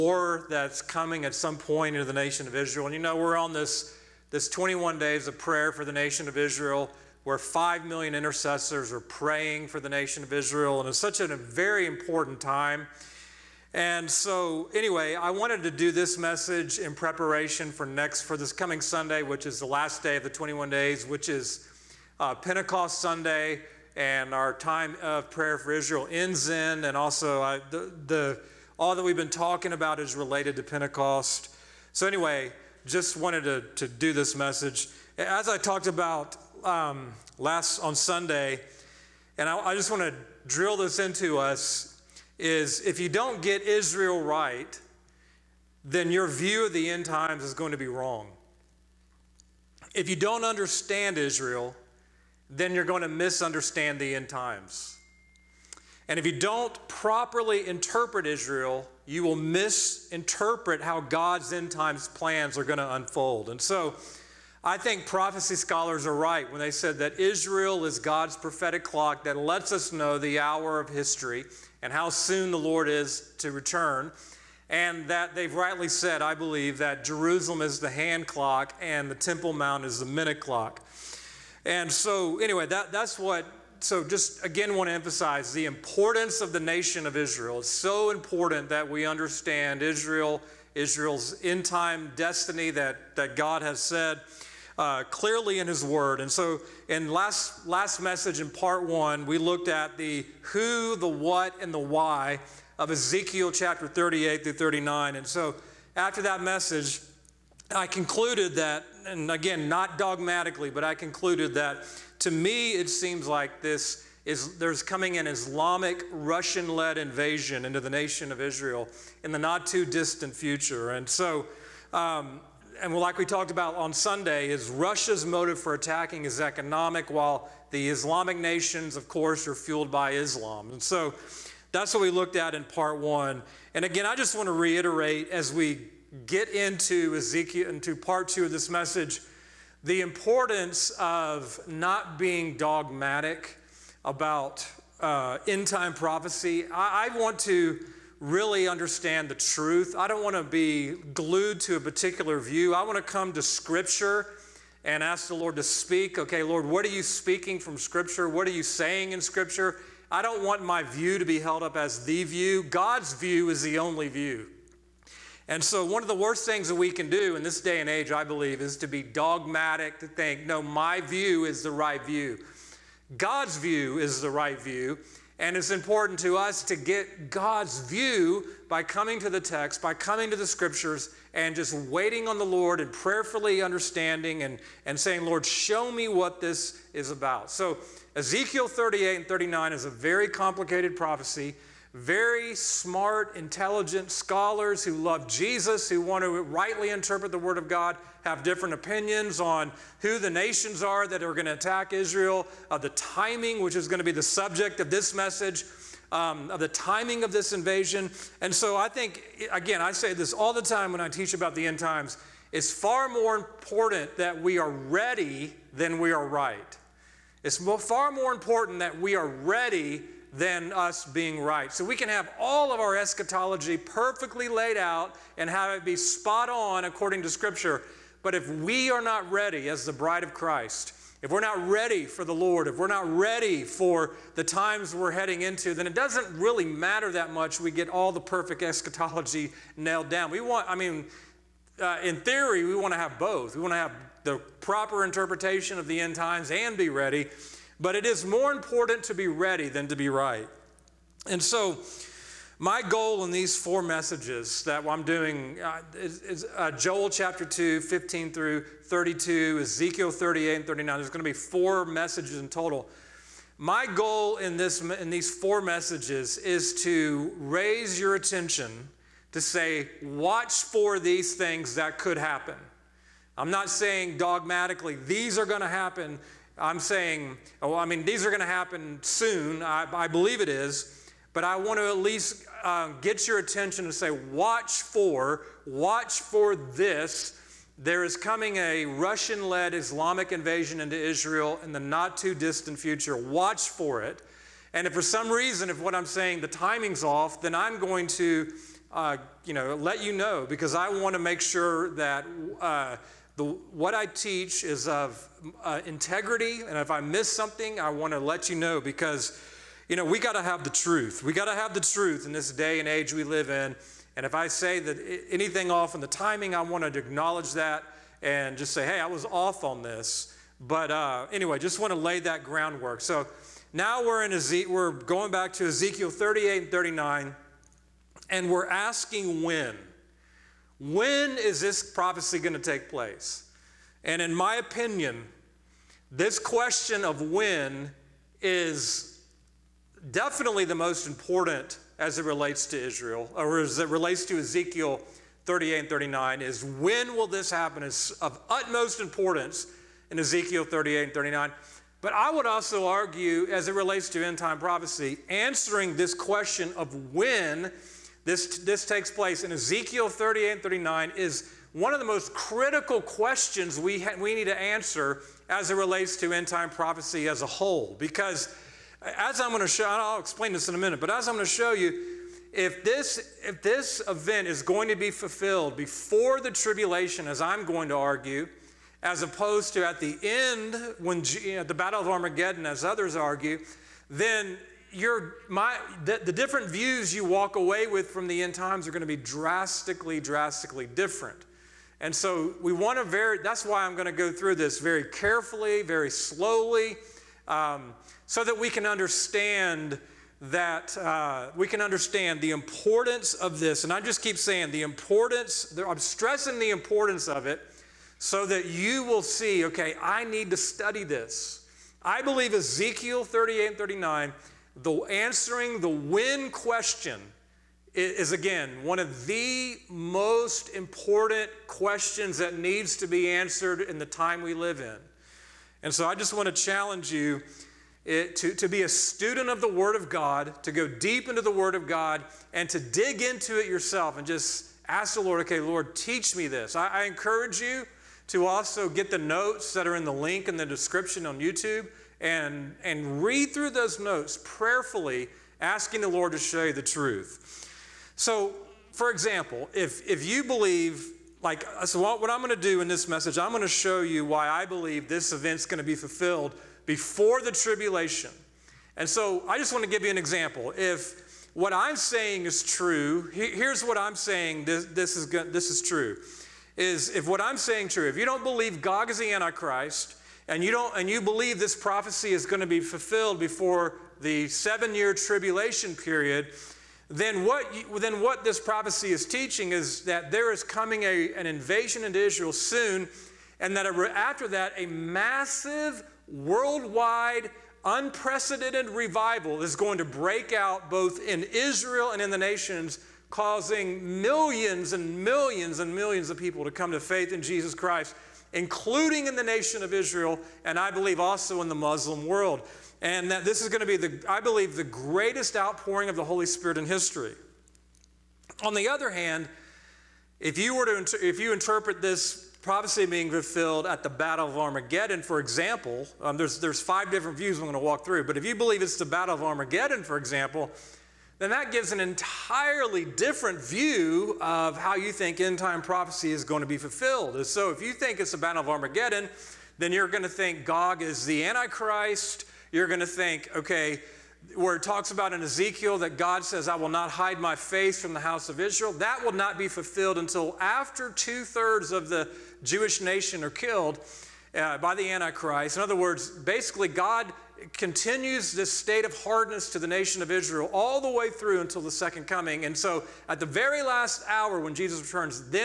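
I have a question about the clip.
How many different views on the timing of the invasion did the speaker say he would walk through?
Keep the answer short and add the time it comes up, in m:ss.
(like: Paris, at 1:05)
5, at 8:36.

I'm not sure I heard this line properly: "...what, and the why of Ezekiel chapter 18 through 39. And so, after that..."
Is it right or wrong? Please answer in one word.
wrong.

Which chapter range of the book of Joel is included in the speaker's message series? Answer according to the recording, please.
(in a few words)
Chapter 2, 15 through 32.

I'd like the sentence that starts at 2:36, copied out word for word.
Okay, Lord, what are you speaking from Scripture?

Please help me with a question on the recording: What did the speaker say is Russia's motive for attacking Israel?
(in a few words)
Economic.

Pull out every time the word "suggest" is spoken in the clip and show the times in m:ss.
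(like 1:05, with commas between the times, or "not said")
not said.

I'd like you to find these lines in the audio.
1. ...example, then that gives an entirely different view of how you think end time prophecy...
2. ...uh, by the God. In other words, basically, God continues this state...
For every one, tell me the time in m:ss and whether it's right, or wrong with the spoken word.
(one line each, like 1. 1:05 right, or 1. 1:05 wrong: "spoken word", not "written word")
1. 8:40 right
2. 9:04 wrong: "Antichrist", not "God".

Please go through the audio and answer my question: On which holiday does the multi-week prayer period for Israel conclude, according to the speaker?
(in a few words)
Pentecost Sunday.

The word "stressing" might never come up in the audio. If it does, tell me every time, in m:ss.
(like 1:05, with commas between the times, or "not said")
6:45.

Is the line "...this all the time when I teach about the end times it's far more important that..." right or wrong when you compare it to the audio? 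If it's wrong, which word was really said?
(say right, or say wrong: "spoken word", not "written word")
right.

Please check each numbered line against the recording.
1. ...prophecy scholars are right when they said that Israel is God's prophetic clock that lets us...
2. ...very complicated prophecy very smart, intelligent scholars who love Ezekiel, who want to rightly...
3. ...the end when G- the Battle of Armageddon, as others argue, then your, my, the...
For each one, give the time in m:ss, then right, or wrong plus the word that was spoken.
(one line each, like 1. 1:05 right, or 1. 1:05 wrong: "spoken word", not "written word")
1. 1:05 right
2. 3:09 wrong: "Jesus", not "Ezekiel"
3. 6:20 right.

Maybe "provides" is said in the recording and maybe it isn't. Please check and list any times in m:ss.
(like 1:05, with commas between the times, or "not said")
not said.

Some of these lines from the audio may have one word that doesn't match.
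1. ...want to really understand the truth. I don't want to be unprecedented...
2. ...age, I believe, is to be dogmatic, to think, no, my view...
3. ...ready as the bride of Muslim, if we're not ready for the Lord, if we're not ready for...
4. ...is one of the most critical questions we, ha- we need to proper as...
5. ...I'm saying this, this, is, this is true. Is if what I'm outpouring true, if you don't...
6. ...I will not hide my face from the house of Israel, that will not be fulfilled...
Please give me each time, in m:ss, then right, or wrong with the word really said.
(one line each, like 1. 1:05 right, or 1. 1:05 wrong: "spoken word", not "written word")
1. 2:27 wrong: "glued", not "unprecedented"
2. 2:47 right
3. 3:49 wrong: "Christ", not "Muslim"
4. 6:01 wrong: "answer", not "proper"
5. 7:43 wrong: "saying", not "outpouring"
6. 8:56 right.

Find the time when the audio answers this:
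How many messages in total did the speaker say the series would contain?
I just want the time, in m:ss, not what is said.
4:21.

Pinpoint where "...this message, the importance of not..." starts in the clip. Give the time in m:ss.
2:18.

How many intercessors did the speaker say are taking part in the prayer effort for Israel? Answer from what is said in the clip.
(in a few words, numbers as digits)
5 million.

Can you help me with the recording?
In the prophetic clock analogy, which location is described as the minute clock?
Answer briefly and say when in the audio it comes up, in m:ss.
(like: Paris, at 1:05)
Temple Mount, at 1:19.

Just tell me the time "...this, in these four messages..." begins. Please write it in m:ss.
4:24.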